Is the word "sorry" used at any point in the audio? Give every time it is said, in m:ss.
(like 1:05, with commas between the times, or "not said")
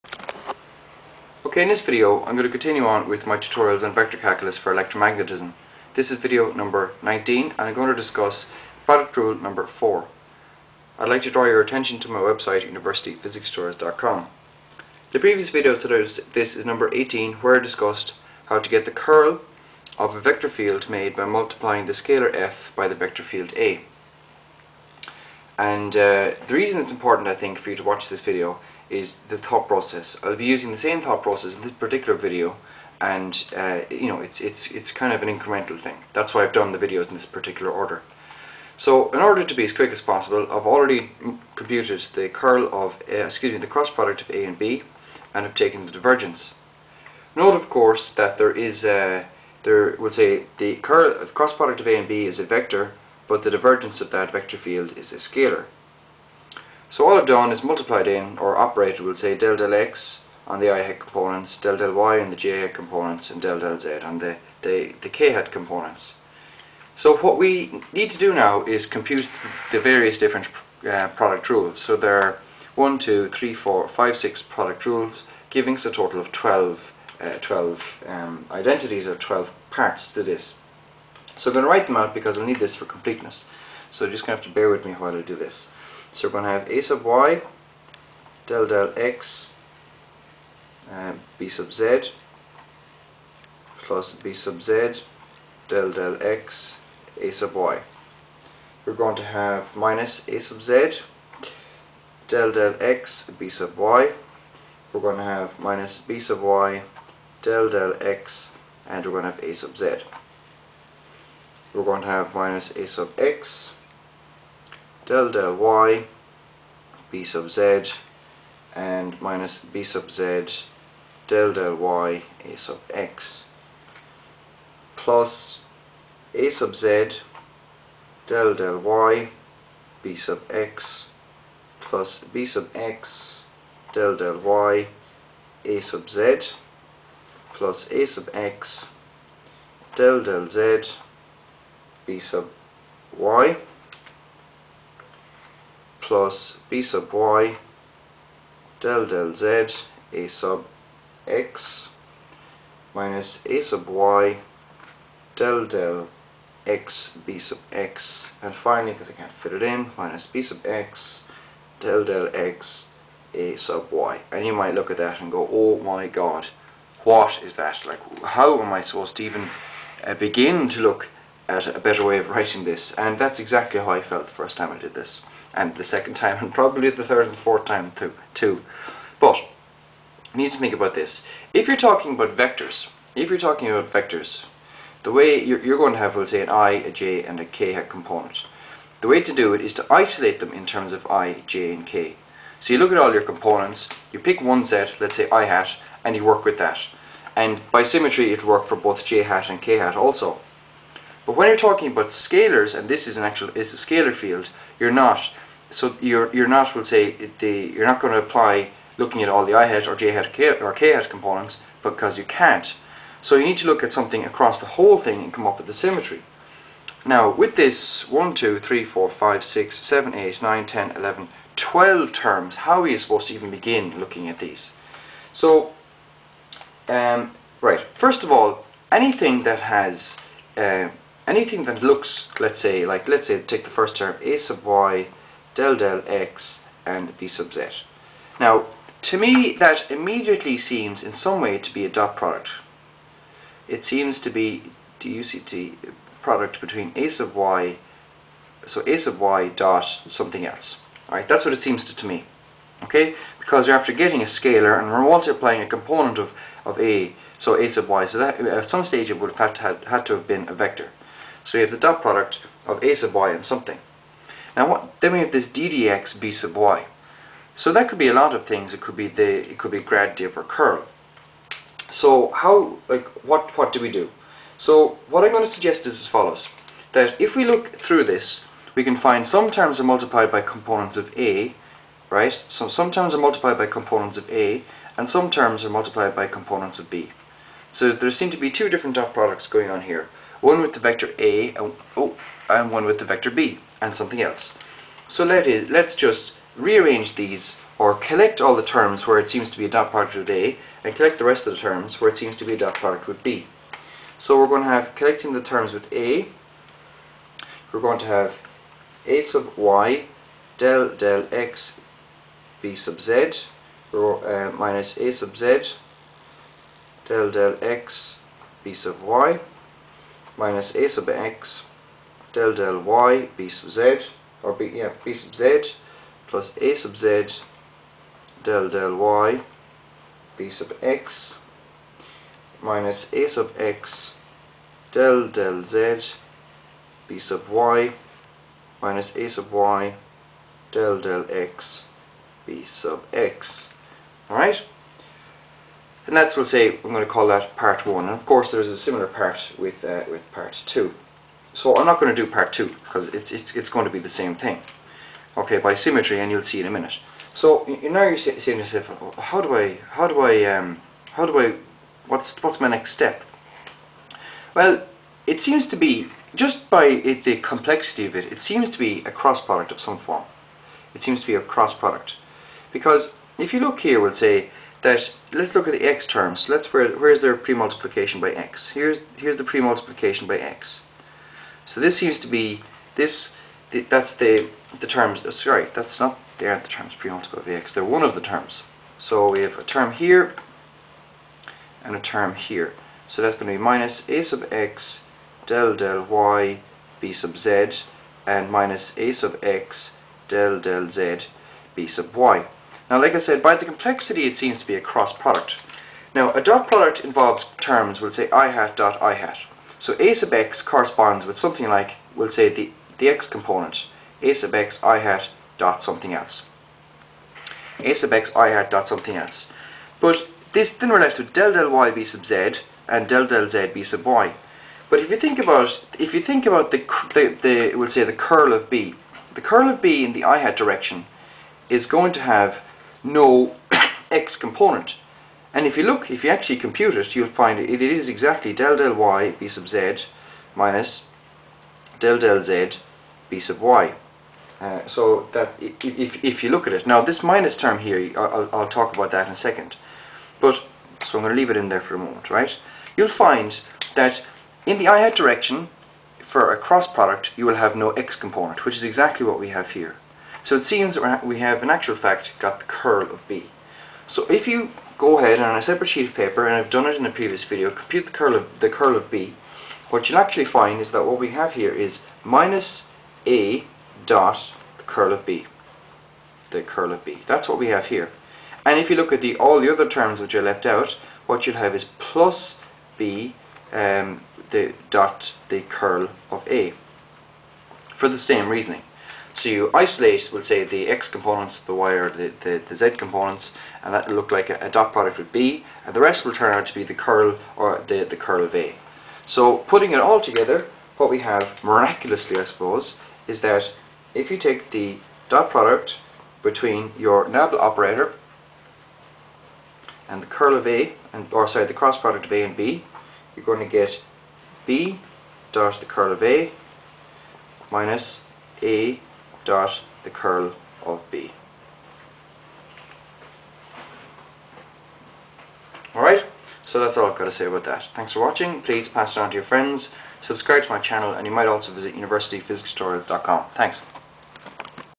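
6:25, 8:31.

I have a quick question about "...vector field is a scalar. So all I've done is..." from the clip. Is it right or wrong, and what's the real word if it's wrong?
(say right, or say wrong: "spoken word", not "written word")
right.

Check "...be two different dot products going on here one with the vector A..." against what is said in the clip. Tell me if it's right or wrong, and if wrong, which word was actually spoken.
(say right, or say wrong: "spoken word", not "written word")
right.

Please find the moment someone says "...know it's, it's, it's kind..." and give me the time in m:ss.
0:34.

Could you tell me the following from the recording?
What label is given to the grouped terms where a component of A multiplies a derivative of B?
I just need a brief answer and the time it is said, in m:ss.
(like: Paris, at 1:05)
part one, at 5:47.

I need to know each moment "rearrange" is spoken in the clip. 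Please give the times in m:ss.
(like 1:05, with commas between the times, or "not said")
4:56.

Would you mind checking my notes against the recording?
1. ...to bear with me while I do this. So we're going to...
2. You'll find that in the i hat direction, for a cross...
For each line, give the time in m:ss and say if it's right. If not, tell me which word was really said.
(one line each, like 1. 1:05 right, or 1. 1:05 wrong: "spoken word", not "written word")
1. 1:24 right
2. 7:32 right.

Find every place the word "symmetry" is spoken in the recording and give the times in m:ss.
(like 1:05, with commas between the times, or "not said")
3:17, 3:35, 5:55.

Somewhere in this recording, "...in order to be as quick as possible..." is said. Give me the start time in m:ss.
0:39.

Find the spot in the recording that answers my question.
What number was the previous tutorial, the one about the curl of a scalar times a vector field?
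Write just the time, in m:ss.
0:16.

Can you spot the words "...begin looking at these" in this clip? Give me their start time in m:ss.
3:43.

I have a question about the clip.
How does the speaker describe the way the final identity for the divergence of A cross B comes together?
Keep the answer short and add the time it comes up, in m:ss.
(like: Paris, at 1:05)
miraculously, at 8:21.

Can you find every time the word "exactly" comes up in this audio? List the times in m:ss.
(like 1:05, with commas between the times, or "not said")
2:53, 7:18, 7:38.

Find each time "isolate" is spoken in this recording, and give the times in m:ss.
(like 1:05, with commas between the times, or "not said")
3:09, 8:09.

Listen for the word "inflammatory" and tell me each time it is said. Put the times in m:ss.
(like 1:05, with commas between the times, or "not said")
not said.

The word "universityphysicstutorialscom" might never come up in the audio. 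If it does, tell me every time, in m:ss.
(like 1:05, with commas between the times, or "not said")
0:12, 8:51.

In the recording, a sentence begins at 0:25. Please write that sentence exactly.
And uh, the reason it's important I think for you to watch this video is the thought process.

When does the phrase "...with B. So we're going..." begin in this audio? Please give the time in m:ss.
5:03.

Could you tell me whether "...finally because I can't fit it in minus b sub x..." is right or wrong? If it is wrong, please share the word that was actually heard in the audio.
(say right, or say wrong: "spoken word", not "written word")
right.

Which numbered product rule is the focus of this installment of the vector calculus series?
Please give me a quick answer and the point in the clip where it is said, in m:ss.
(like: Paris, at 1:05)
4, at 0:08.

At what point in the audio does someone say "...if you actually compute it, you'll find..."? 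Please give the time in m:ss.
7:16.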